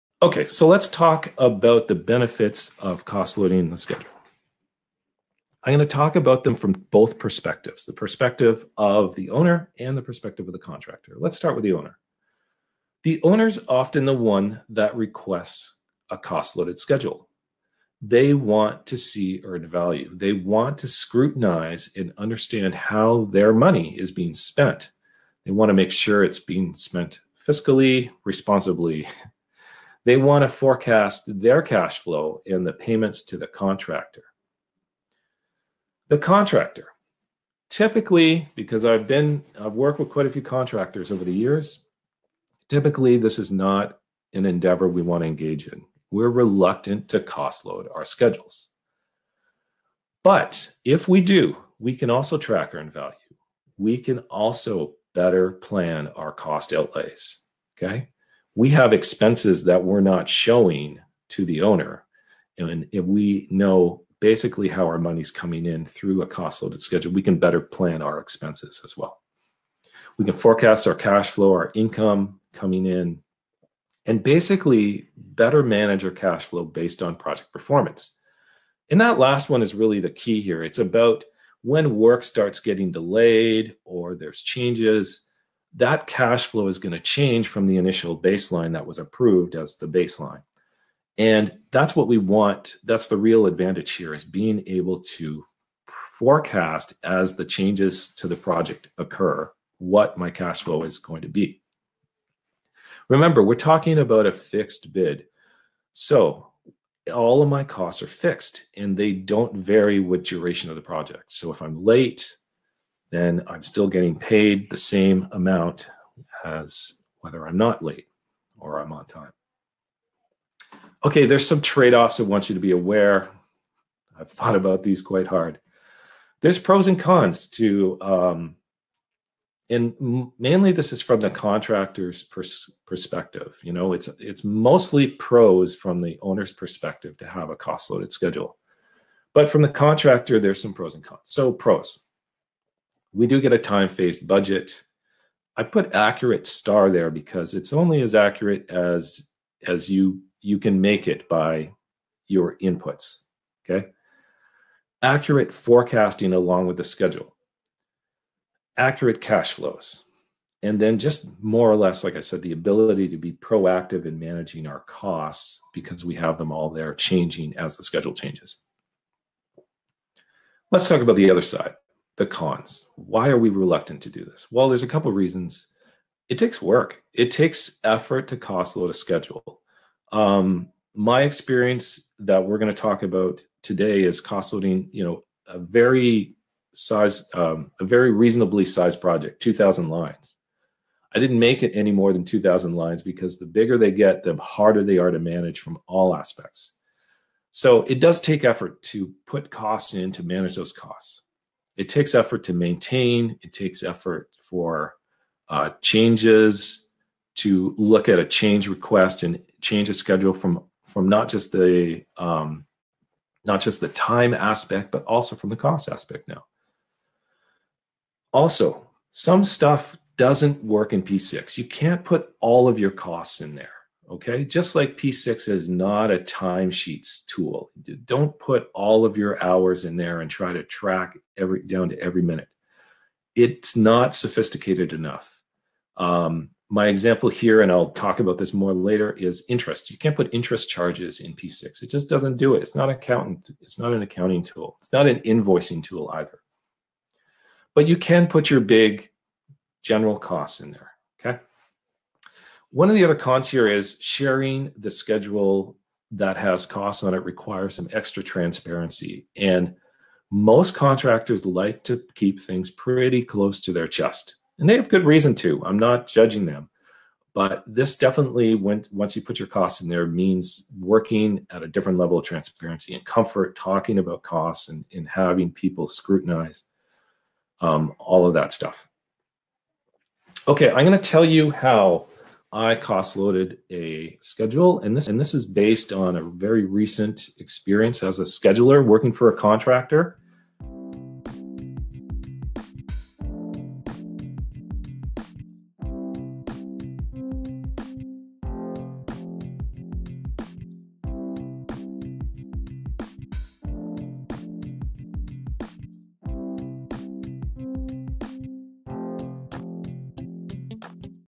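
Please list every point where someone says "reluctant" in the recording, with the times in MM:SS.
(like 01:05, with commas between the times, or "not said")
00:46, 02:53.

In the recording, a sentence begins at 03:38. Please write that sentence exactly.
Also, some stuff doesn't work in P6.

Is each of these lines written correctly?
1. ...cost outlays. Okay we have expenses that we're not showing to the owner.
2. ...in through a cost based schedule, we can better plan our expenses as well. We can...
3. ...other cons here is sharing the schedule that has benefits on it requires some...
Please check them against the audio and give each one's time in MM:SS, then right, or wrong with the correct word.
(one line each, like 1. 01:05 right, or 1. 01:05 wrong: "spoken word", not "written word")
1. 00:56 right
2. 01:05 wrong: "loaded", not "based"
3. 04:13 wrong: "costs", not "benefits".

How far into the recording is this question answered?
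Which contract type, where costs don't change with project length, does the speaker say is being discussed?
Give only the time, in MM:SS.
01:44.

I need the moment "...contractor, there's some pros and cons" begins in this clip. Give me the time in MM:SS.
02:19.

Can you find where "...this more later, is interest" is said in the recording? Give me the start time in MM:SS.
03:58.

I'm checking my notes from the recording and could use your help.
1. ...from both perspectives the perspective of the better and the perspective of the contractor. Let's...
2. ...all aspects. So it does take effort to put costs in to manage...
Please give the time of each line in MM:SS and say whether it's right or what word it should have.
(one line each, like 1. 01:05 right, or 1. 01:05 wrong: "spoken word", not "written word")
1. 00:06 wrong: "owner", not "better"
2. 03:15 right.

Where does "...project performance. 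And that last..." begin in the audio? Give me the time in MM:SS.
01:17.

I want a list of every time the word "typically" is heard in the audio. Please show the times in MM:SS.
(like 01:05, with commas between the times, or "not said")
00:37, 00:42.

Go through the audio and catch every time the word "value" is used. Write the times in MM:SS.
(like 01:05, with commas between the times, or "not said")
00:19, 00:52.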